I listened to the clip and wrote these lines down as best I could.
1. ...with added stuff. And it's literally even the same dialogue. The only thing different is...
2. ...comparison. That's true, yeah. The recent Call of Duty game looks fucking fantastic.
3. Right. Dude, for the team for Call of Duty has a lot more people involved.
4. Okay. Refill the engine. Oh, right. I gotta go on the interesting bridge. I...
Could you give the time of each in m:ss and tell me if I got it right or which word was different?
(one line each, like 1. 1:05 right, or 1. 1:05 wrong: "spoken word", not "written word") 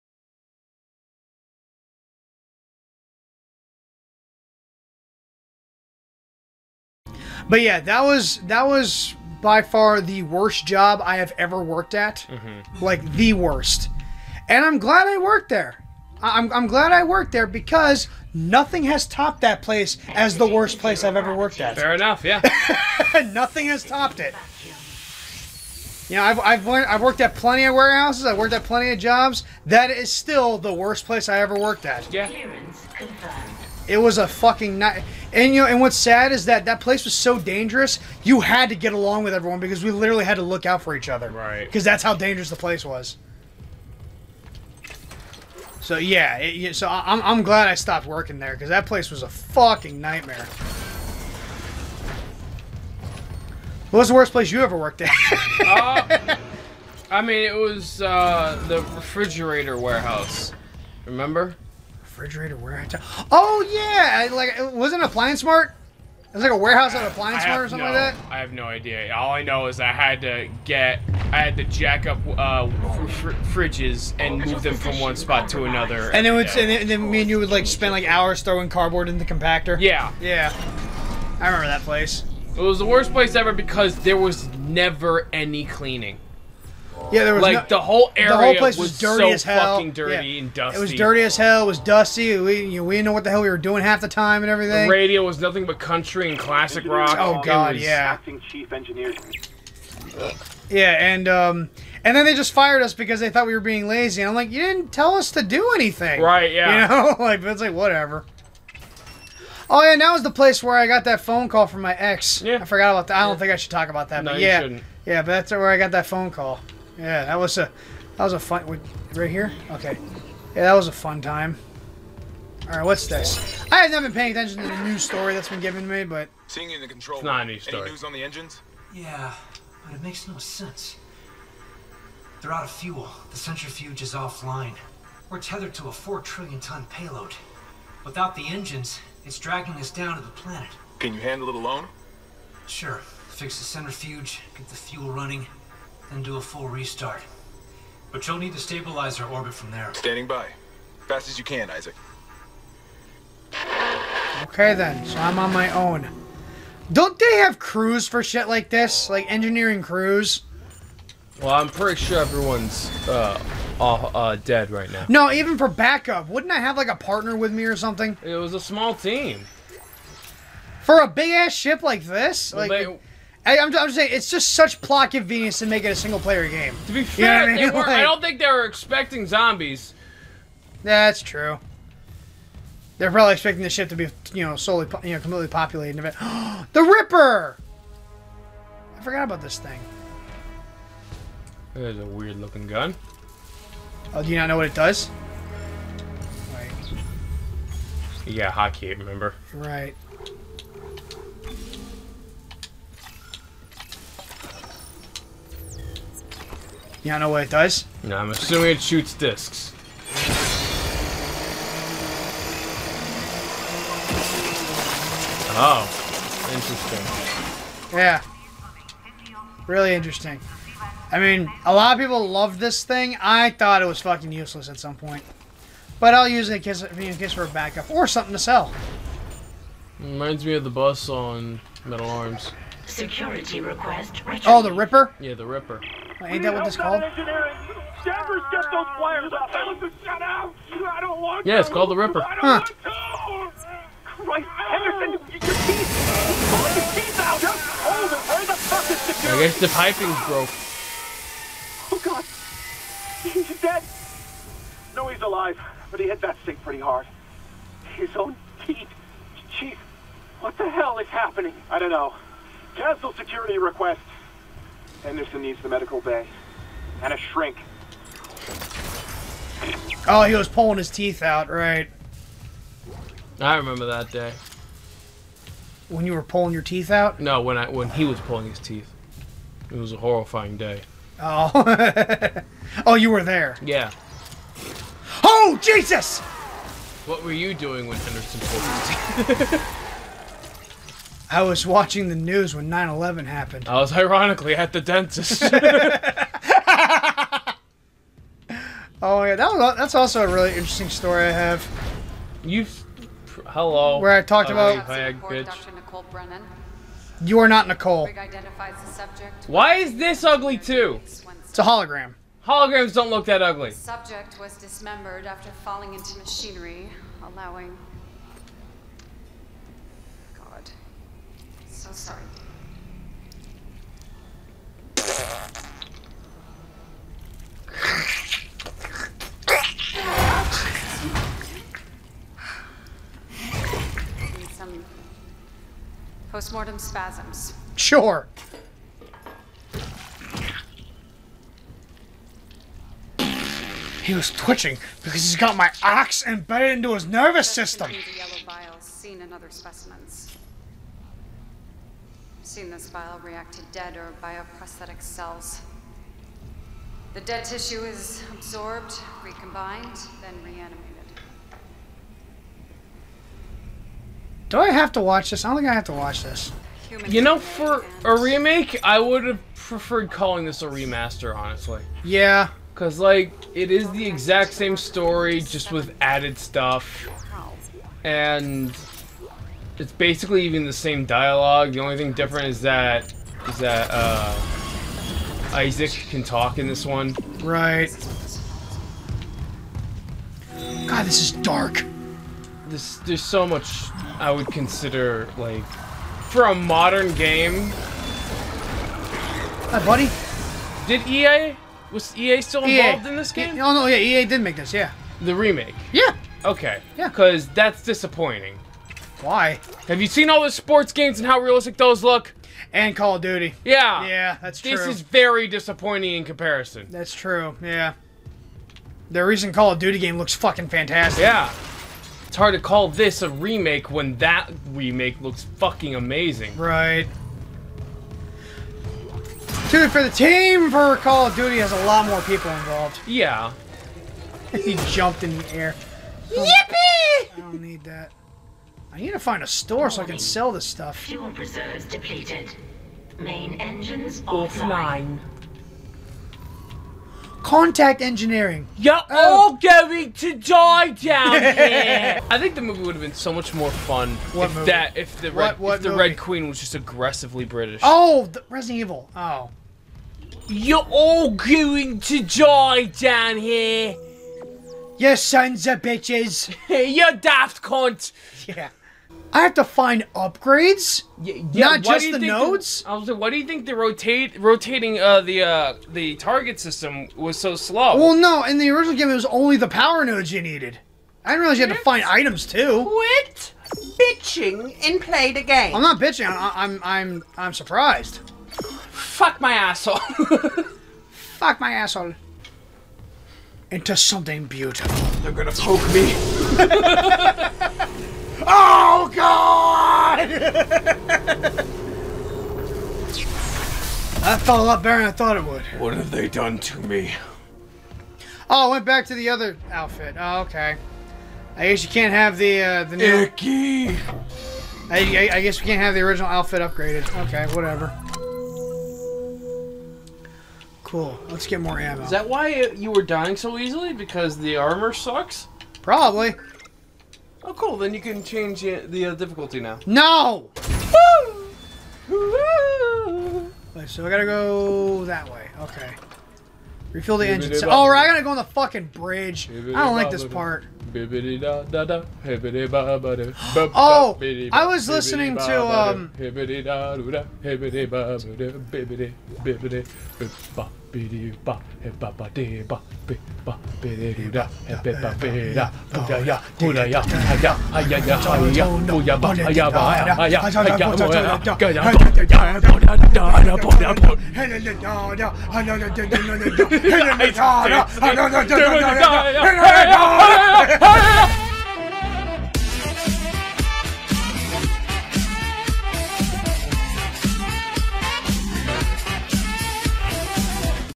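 1. 6:15 wrong: "basically", not "literally"
2. 6:56 right
3. 7:06 right
4. 8:55 wrong: "fucking", not "interesting".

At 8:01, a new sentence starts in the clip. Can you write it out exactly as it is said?
I didn't realize you had to find items too.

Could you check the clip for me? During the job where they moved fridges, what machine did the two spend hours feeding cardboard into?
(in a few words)
compactor.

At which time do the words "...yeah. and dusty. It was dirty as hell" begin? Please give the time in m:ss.
1:30.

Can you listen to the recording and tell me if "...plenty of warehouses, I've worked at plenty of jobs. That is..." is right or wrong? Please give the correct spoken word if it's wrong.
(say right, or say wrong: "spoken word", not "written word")
right.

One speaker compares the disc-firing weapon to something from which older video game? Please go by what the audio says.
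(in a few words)
Metal Arms.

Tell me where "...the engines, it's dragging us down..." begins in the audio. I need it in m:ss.
2:18.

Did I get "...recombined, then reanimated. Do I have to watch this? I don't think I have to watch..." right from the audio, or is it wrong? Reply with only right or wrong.
right.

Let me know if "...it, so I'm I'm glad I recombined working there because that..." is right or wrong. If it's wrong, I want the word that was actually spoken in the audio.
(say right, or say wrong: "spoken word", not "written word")
wrong: "stopped", not "recombined".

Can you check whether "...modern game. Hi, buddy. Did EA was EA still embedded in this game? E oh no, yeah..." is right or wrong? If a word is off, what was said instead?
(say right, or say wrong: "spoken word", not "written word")
wrong: "involved", not "embedded".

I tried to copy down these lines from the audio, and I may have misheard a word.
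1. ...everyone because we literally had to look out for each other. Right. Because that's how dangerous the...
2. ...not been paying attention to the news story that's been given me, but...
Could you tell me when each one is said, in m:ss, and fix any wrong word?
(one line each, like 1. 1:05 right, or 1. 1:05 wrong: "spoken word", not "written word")
1. 0:39 right
2. 2:03 right.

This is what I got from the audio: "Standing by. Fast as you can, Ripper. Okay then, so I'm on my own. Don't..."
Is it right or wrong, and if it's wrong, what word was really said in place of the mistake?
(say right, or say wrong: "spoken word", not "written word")
wrong: "Isaac", not "Ripper".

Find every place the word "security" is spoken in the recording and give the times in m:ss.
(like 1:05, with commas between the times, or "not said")
3:52, 4:08, 4:23.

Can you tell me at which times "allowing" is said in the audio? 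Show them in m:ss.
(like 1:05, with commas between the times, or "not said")
5:17.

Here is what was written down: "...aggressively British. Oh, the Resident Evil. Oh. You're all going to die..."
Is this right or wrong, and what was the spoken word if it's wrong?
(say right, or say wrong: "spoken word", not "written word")
right.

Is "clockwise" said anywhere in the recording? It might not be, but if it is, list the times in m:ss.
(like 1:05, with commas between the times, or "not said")
not said.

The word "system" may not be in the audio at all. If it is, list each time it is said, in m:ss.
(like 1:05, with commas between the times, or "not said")
5:47, 7:56.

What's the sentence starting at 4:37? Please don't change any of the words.
No, when I when he was pulling his teeth.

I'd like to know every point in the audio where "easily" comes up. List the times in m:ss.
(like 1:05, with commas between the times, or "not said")
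8:43.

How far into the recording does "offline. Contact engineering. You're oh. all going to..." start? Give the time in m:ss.
7:25.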